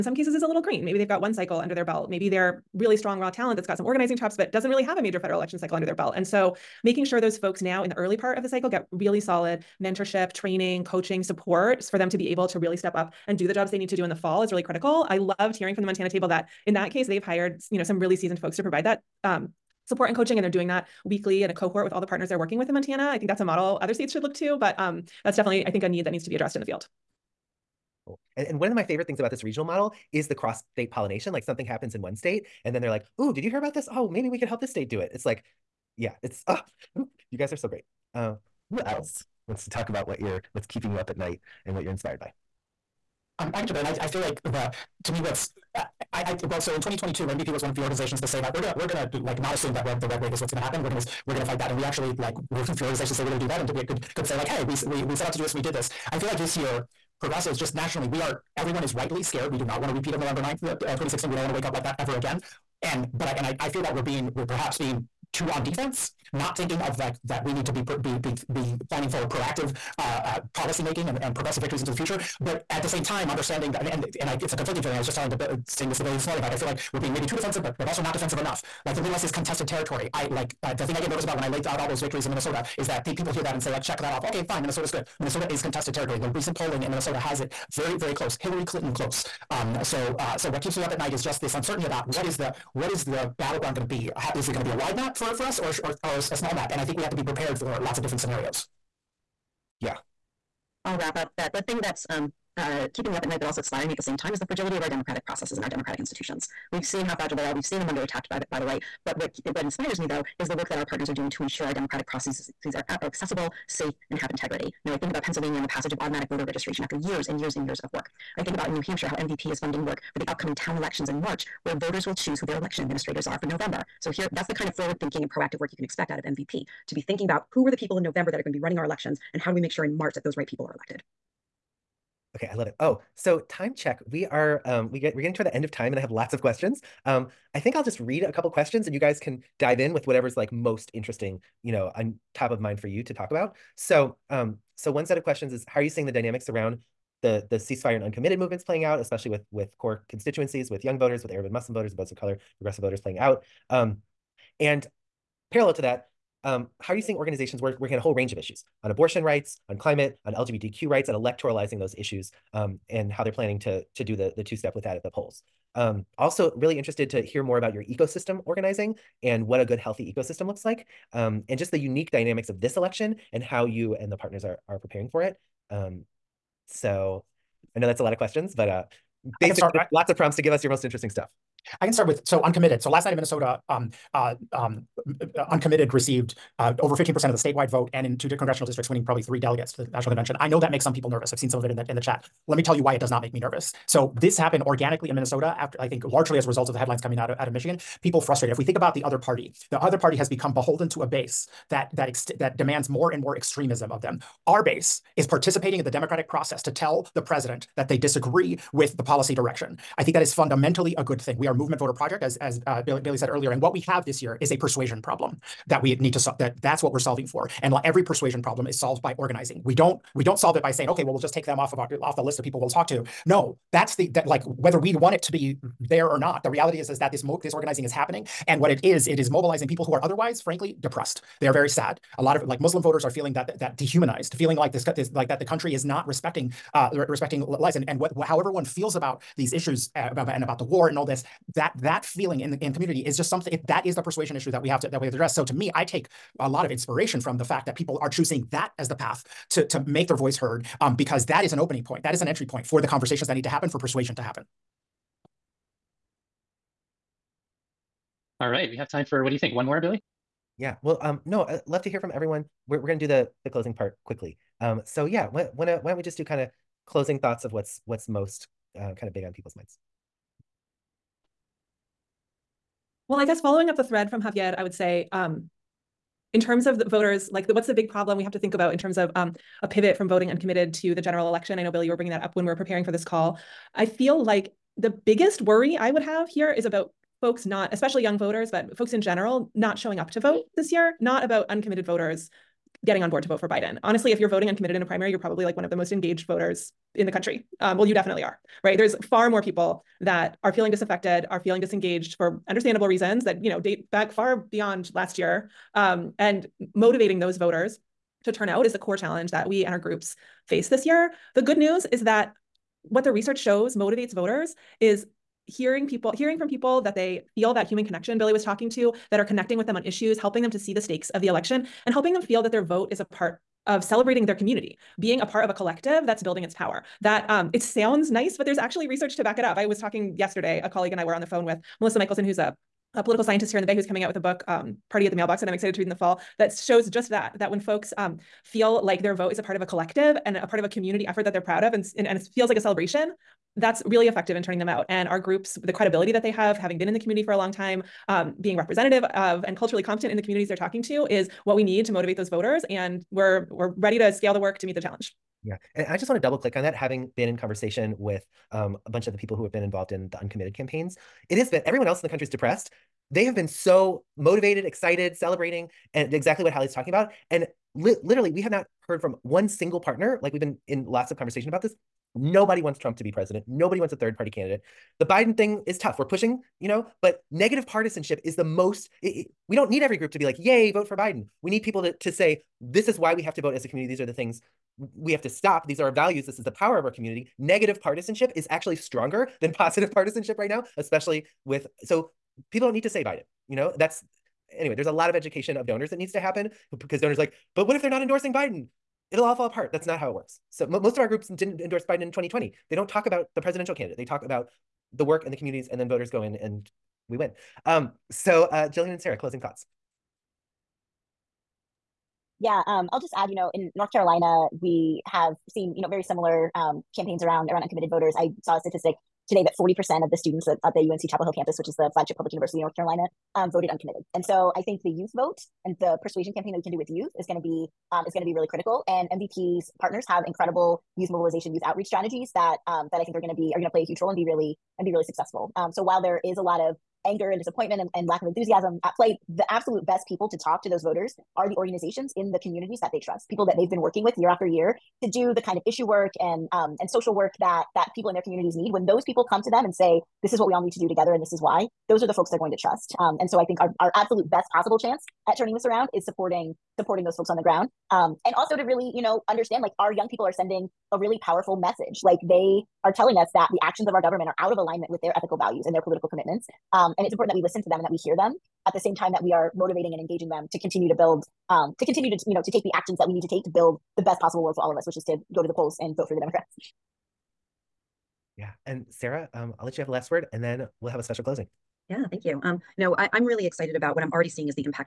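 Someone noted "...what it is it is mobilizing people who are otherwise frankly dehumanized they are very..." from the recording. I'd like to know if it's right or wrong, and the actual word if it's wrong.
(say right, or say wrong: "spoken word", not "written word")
wrong: "depressed", not "dehumanized".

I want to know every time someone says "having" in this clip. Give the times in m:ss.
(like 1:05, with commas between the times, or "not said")
5:46, 5:56.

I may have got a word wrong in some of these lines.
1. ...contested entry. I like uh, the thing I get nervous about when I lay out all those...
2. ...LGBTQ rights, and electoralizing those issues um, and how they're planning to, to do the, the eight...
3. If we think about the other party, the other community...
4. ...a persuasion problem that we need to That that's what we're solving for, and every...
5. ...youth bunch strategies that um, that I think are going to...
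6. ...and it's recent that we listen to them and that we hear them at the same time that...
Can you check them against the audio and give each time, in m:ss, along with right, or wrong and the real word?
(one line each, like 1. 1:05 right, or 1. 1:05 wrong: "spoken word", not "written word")
1. 1:19 wrong: "territory", not "entry"
2. 2:40 wrong: "two", not "eight"
3. 3:18 wrong: "party", not "community"
4. 3:34 right
5. 7:11 wrong: "outreach", not "bunch"
6. 7:46 wrong: "important", not "recent".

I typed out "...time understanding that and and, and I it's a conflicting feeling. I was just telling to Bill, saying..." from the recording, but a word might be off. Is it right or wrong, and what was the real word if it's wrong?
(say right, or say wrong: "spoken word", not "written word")
right.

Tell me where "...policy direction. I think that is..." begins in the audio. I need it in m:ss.
3:29.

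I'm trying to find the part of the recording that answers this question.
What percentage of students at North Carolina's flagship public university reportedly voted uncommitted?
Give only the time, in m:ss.
6:59.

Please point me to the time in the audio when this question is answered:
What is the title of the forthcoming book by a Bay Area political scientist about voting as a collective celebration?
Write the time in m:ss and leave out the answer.
5:34.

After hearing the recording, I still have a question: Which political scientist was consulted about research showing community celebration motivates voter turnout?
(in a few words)
Melissa Michelson.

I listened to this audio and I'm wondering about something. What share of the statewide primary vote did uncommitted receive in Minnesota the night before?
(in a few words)
over 15%.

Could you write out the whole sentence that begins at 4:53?
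Honestly, if you're voting uncommitted in a primary, you're probably like one of the most engaged voters in the country.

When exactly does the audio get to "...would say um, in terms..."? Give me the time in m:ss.
4:34.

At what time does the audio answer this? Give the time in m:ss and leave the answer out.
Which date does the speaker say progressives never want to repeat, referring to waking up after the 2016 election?
1:00.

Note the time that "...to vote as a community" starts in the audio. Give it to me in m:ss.
6:23.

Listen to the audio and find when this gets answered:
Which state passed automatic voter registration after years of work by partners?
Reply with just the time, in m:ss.
1:55.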